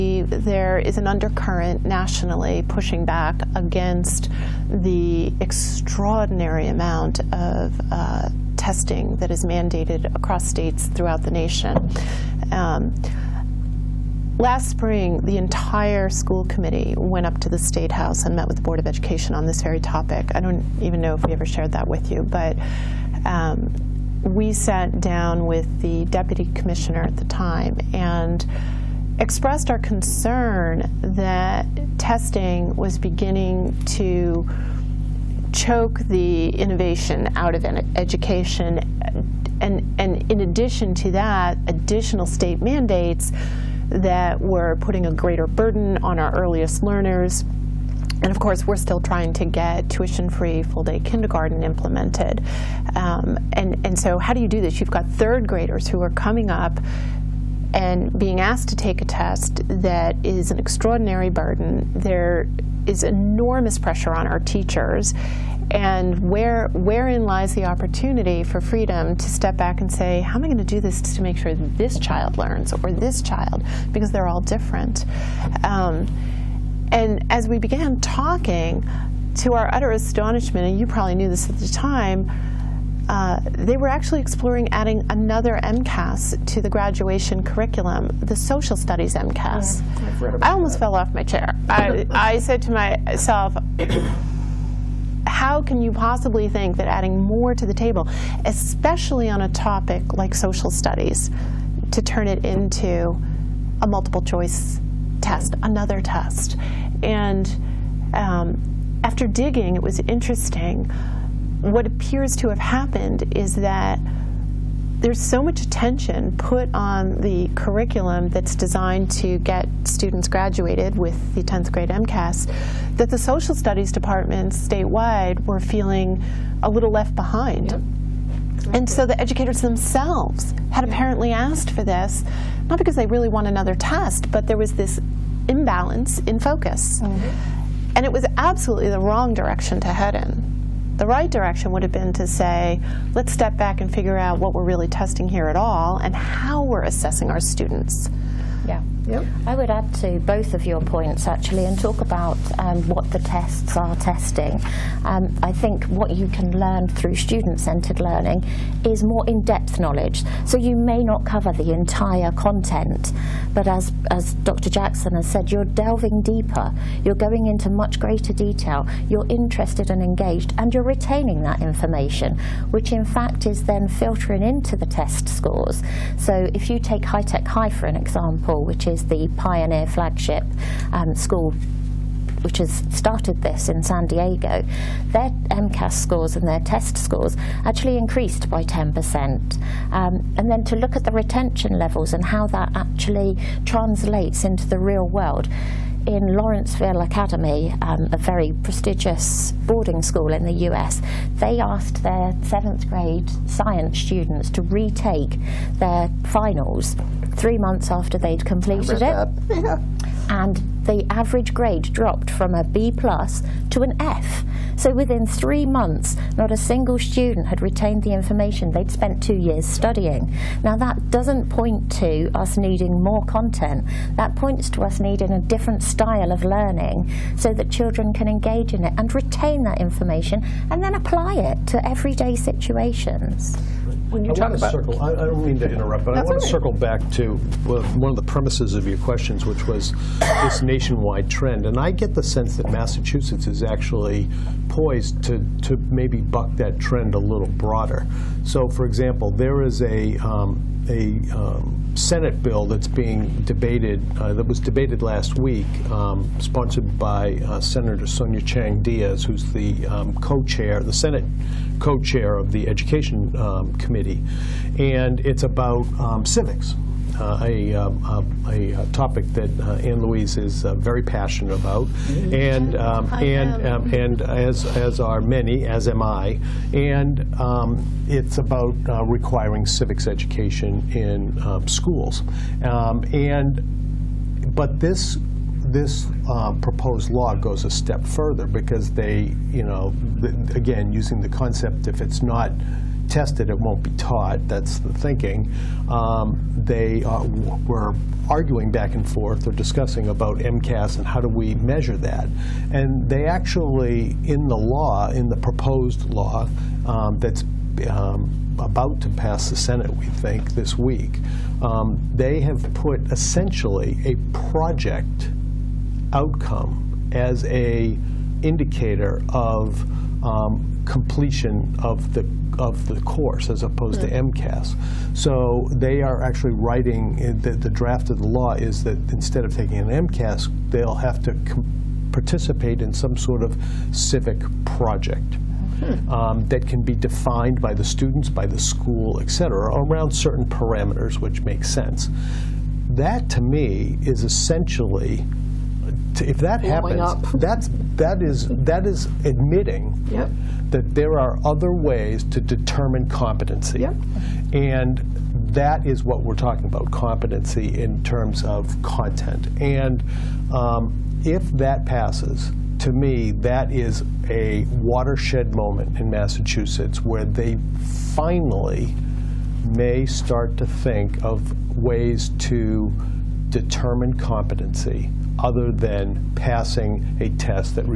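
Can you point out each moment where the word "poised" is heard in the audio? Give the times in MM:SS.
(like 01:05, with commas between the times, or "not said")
04:04.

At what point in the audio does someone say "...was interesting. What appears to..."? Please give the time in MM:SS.
01:49.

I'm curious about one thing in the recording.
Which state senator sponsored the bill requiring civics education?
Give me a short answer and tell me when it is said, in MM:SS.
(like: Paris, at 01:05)
Sonia Chang Diaz, at 04:18.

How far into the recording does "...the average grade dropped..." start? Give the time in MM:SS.
03:30.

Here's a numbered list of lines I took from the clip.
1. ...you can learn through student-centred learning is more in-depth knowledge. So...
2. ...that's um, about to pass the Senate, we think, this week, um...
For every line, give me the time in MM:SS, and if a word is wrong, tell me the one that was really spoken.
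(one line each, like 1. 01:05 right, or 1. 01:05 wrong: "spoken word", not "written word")
1. 02:36 right
2. 05:07 right.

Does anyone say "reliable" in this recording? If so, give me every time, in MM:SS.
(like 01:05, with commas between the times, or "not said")
not said.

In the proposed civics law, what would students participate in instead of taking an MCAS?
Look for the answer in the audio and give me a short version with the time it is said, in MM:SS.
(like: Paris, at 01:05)
civic project, at 05:33.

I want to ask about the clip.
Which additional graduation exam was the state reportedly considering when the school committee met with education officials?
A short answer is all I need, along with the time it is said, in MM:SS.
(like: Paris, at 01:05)
social studies MCAS, at 01:28.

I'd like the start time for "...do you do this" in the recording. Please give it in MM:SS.
00:54.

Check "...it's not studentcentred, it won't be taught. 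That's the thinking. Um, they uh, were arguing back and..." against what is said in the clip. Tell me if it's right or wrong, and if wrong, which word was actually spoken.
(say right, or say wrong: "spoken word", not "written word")
wrong: "tested", not "studentcentred".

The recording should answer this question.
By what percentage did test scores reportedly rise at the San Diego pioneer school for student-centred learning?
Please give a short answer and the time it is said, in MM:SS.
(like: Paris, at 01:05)
10%, at 03:08.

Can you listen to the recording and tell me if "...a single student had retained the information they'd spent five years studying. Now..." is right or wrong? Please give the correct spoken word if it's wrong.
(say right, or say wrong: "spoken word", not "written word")
wrong: "two", not "five".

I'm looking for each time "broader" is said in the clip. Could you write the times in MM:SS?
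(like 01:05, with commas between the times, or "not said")
04:07.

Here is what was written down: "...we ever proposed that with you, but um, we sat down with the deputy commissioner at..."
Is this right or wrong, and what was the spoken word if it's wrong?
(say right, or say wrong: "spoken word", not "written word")
wrong: "shared", not "proposed".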